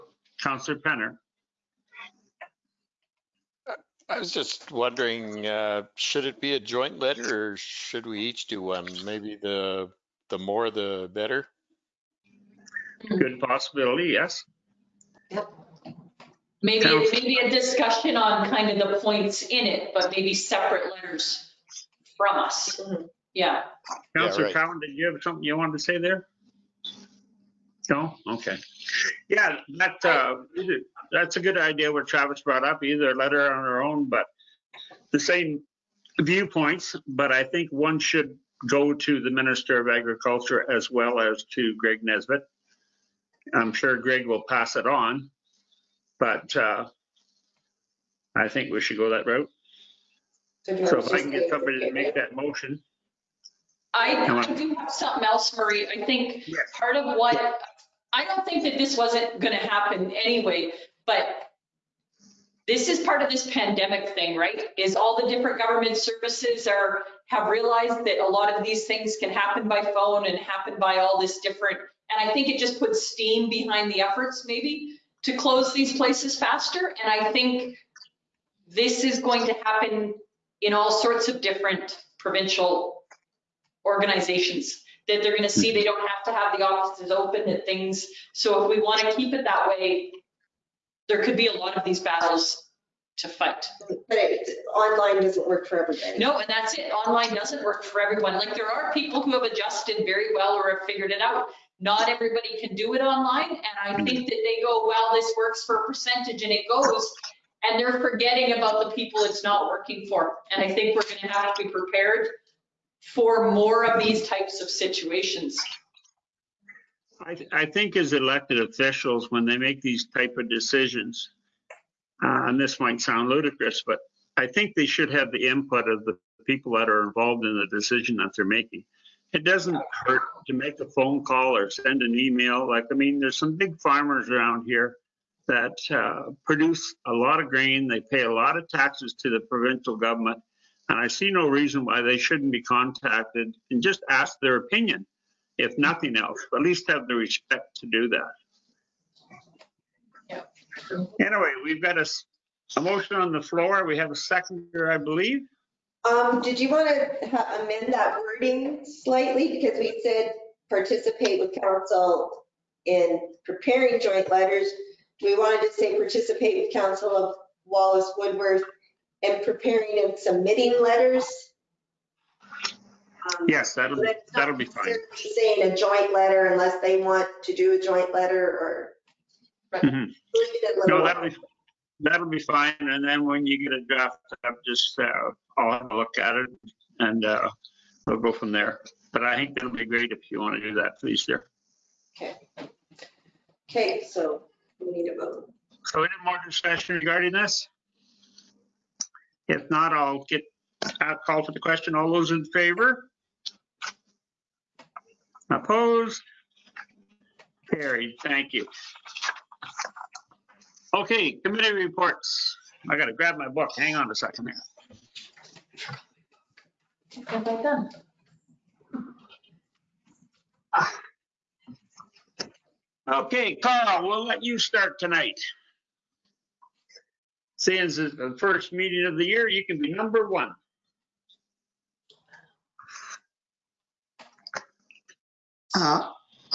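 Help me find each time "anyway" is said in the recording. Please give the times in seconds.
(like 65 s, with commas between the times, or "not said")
60 s, 151 s.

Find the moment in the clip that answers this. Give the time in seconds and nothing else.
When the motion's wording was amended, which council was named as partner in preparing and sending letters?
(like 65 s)
167 s.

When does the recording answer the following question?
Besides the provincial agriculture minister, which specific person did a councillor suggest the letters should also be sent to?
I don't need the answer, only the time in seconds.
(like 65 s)
41 s.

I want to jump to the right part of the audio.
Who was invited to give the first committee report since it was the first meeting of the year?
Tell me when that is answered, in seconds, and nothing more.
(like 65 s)
223 s.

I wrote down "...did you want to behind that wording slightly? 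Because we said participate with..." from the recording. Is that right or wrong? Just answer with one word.
wrong.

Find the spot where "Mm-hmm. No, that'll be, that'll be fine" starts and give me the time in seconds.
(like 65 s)
179 s.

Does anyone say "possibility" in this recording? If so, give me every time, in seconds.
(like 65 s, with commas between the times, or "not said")
13 s.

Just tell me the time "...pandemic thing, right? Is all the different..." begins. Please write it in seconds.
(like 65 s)
63 s.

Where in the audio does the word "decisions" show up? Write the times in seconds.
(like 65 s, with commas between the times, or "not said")
120 s, 127 s.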